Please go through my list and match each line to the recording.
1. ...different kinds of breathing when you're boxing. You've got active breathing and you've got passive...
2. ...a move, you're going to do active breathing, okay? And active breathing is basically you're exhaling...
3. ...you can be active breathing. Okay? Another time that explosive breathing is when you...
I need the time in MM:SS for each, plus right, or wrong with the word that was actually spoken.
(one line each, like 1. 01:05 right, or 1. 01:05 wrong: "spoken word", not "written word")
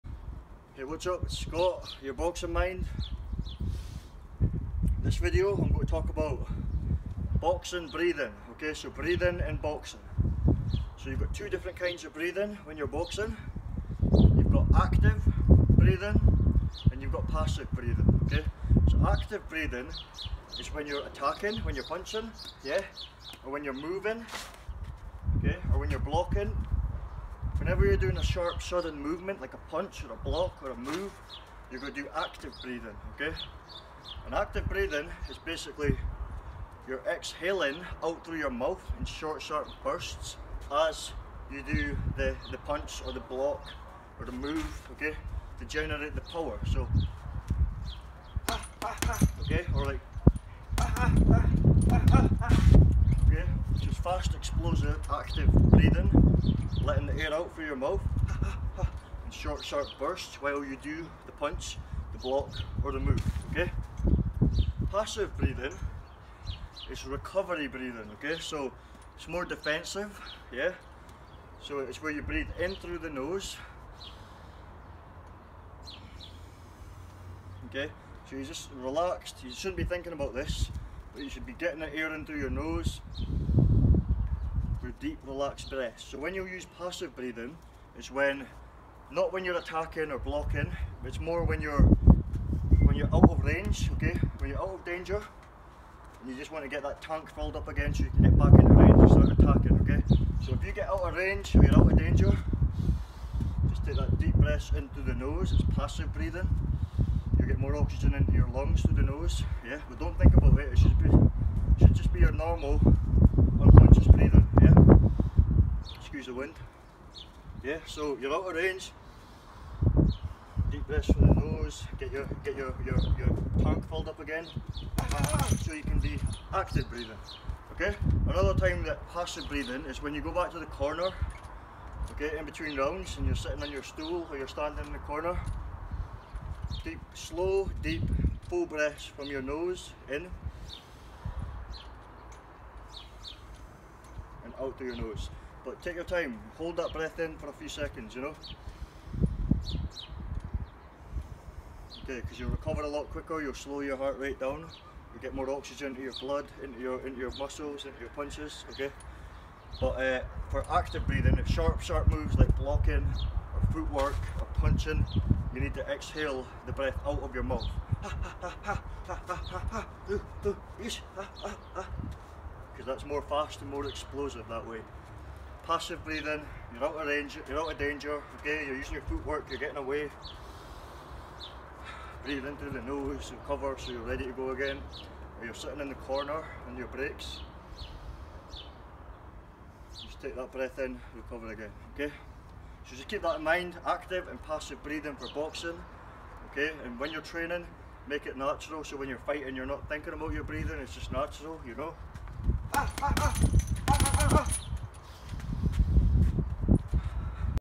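1. 00:11 right
2. 00:30 right
3. 02:05 wrong: "passive", not "explosive".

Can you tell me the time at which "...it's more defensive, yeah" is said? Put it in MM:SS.
01:09.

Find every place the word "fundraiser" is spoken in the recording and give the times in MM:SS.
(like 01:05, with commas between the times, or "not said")
not said.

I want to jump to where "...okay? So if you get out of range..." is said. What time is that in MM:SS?
01:39.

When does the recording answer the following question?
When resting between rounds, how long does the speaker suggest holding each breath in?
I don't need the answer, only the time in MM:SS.
02:27.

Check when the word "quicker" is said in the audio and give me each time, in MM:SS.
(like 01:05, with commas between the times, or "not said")
02:33.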